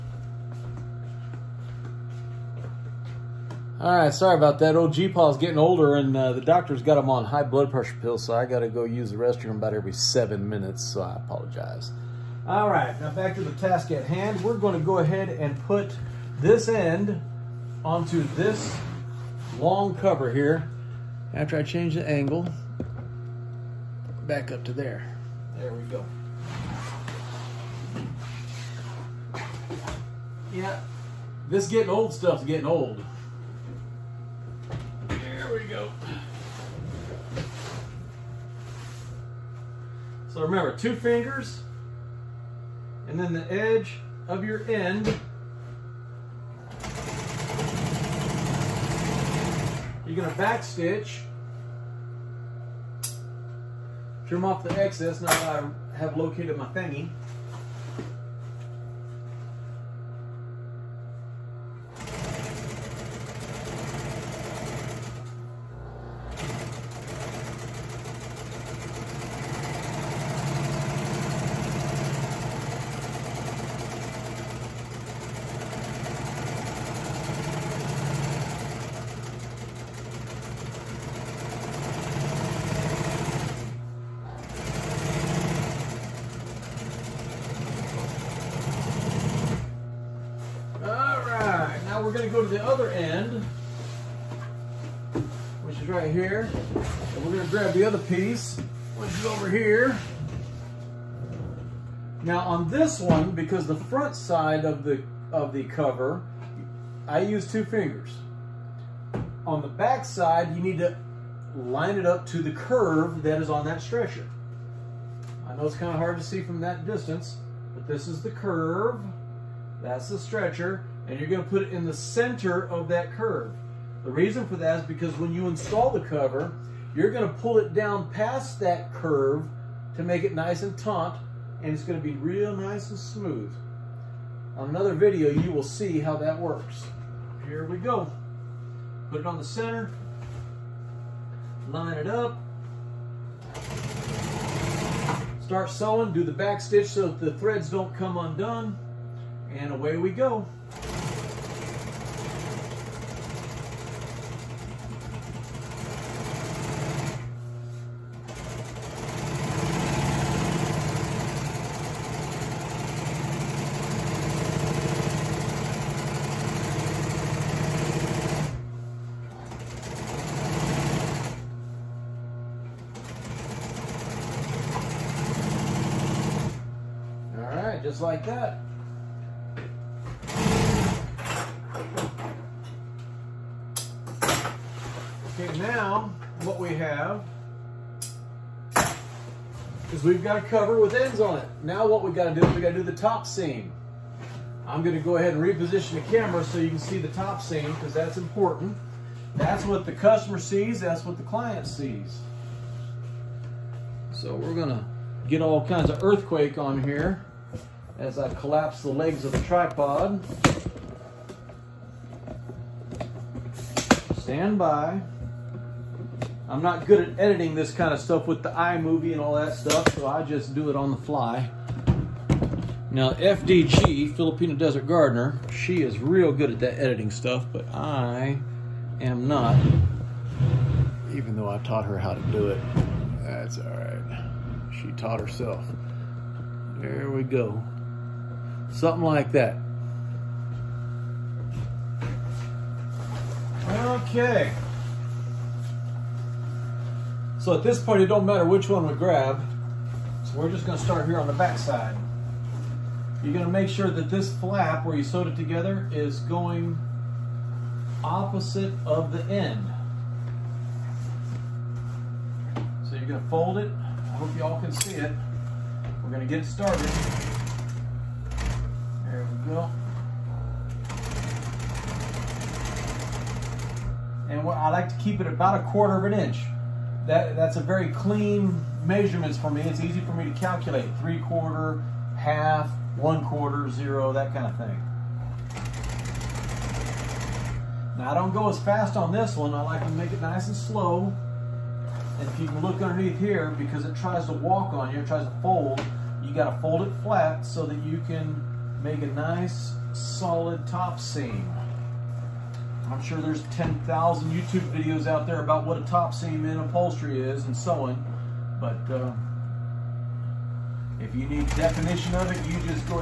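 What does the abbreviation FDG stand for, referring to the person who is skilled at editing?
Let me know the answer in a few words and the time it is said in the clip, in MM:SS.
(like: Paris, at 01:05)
Filipino Desert Gardener, at 03:44.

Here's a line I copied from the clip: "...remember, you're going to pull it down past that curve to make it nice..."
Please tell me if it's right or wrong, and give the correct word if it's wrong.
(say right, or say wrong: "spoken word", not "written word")
wrong: "cover", not "remember".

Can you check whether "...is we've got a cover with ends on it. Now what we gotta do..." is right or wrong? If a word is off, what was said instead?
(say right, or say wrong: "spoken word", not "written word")
right.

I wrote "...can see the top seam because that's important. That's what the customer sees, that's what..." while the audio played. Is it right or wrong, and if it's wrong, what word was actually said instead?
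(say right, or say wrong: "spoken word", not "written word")
right.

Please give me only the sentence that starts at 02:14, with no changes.
On another video, you will see how that works.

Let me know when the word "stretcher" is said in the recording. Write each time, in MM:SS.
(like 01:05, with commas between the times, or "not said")
01:53, 02:00.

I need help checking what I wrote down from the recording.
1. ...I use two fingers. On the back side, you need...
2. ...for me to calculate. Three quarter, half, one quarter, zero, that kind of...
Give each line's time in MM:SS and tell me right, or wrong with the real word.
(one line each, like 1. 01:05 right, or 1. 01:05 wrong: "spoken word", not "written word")
1. 01:47 right
2. 04:40 right.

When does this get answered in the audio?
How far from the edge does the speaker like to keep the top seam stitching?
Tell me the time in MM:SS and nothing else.
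04:35.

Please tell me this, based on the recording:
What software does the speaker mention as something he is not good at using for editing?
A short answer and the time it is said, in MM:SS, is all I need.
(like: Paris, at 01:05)
iMovie, at 03:38.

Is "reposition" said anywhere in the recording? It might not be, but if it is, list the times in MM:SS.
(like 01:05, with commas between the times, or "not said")
03:15.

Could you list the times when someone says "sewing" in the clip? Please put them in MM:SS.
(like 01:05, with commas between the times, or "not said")
02:25, 05:07.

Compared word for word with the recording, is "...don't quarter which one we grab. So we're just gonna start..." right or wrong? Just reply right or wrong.
wrong.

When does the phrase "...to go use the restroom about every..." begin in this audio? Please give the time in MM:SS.
00:08.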